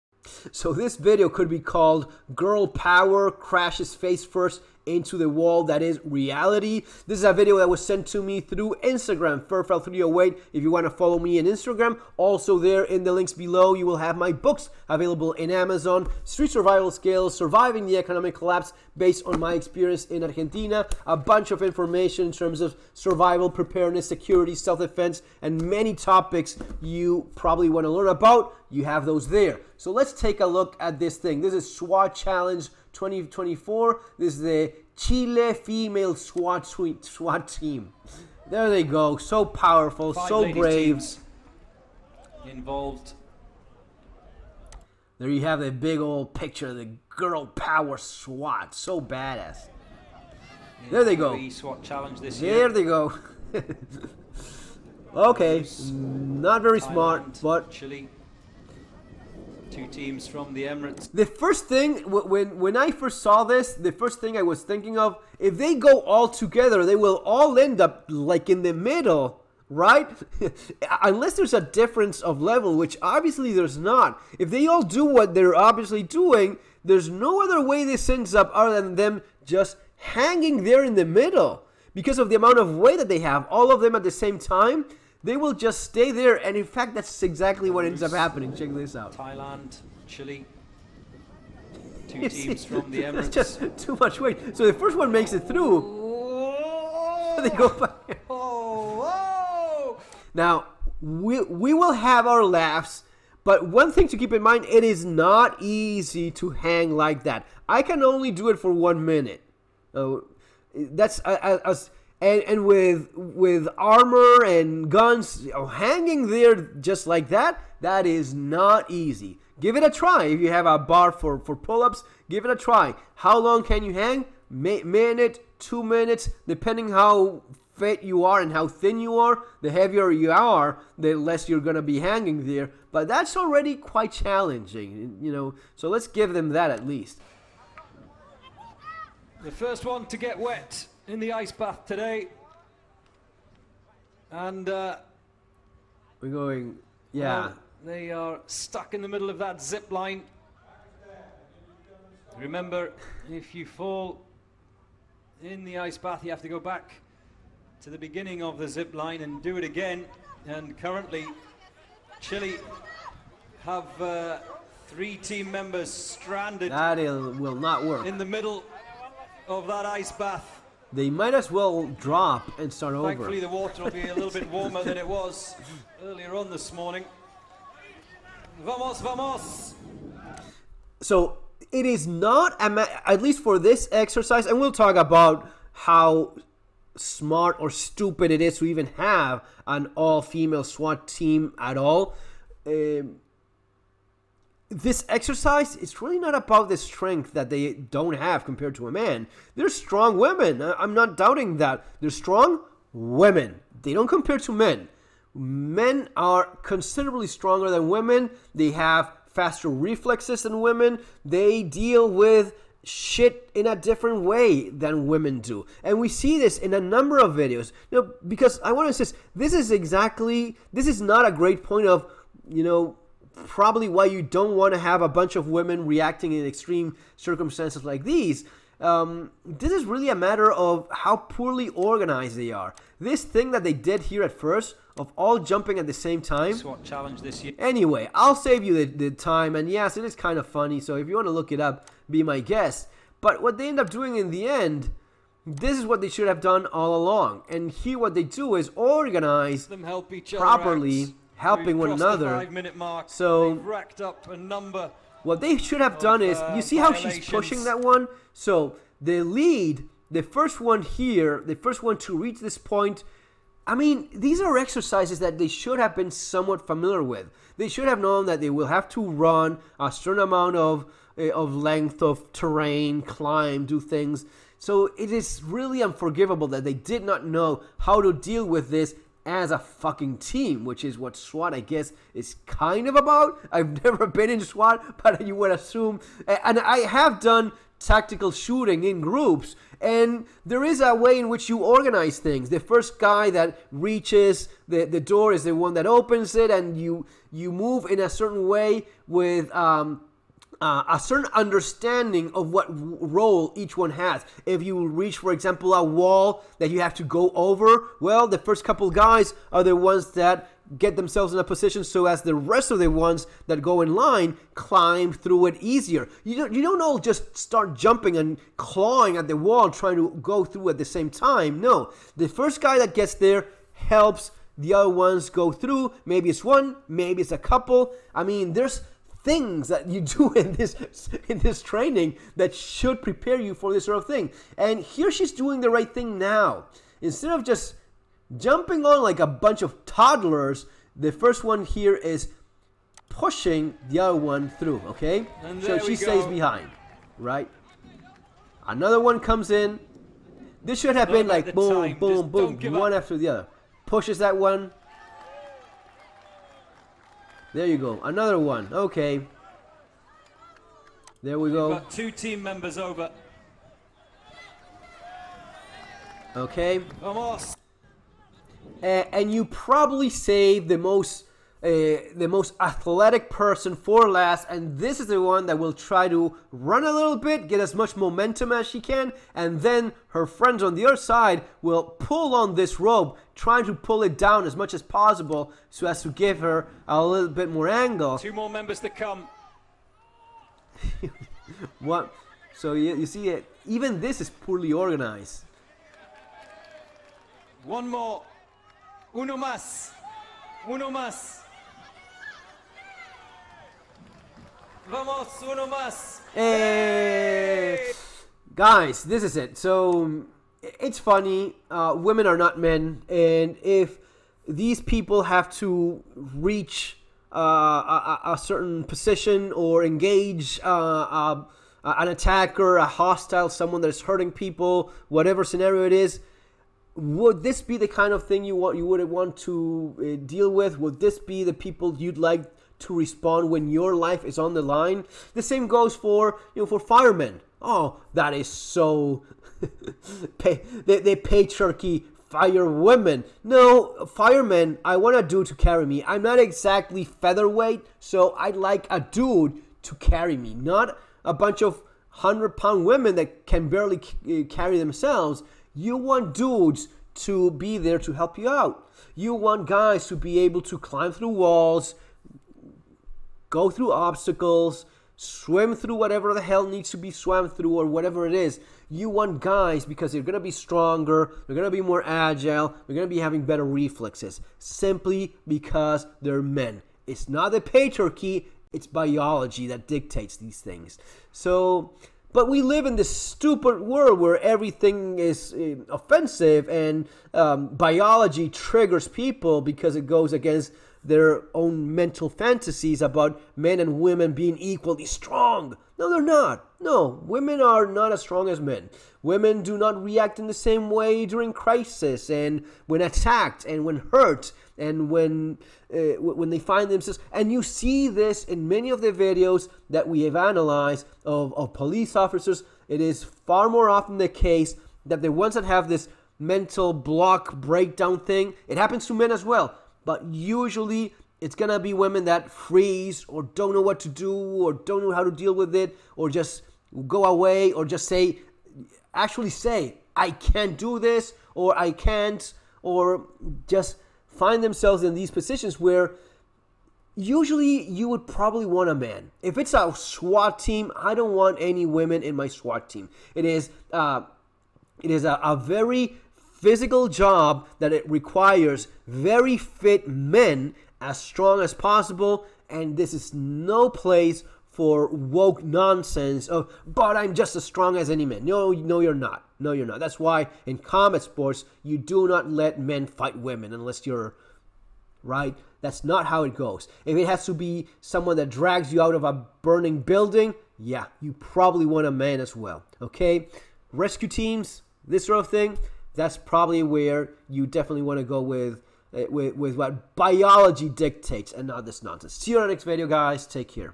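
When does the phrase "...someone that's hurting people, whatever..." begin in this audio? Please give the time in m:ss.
7:03.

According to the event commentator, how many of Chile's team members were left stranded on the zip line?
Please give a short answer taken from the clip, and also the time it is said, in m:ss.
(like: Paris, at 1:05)
3, at 2:44.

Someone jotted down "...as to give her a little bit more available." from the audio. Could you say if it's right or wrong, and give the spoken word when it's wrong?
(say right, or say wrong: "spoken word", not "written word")
wrong: "angle", not "available".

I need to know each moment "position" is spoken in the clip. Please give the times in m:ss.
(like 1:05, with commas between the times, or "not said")
5:11, 6:58, 8:55.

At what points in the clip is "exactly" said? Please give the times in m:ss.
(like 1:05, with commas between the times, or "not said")
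1:27, 3:39, 7:26.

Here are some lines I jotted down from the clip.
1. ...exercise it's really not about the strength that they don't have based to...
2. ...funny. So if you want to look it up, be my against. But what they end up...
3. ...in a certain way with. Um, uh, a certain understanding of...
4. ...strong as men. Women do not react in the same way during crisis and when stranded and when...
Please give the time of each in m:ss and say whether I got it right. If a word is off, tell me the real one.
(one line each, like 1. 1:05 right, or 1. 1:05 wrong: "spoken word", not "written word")
1. 3:15 wrong: "compared", not "based"
2. 4:00 wrong: "guest", not "against"
3. 4:57 right
4. 8:18 wrong: "attacked", not "stranded".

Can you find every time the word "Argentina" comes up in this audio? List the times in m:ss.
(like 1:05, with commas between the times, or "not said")
0:20.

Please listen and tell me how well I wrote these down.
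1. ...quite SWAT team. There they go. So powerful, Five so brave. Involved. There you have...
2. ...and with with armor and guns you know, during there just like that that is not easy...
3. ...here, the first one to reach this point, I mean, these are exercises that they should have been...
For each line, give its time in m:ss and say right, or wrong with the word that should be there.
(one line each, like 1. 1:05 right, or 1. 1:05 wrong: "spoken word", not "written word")
1. 0:36 wrong: "suite", not "quite"
2. 1:52 wrong: "hanging", not "during"
3. 4:20 right.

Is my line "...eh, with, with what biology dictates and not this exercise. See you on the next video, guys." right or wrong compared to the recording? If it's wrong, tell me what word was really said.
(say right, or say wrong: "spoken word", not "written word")
wrong: "nonsense", not "exercise".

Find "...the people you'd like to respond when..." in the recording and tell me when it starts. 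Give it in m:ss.
7:11.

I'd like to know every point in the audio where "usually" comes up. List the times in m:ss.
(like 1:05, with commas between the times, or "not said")
8:40, 8:57.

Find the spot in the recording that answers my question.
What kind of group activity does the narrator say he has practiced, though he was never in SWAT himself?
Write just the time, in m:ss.
4:47.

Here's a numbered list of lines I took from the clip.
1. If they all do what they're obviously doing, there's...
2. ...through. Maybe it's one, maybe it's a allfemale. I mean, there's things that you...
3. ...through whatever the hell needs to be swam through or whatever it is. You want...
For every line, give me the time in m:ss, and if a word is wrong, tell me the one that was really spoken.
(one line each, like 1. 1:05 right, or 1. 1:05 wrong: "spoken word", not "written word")
1. 1:14 right
2. 5:25 wrong: "couple", not "allfemale"
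3. 7:45 right.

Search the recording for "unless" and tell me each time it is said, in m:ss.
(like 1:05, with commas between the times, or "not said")
1:11, 9:23.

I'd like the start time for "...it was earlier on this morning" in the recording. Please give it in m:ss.
2:54.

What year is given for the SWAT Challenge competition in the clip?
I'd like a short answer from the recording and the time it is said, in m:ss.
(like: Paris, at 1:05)
2024, at 0:32.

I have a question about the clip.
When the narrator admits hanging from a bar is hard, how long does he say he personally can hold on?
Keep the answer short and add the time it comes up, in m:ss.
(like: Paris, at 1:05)
1 minute, at 1:48.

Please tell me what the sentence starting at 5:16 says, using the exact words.
You don't, you don't all just start jumping and clawing at the wall trying to go through at the same time.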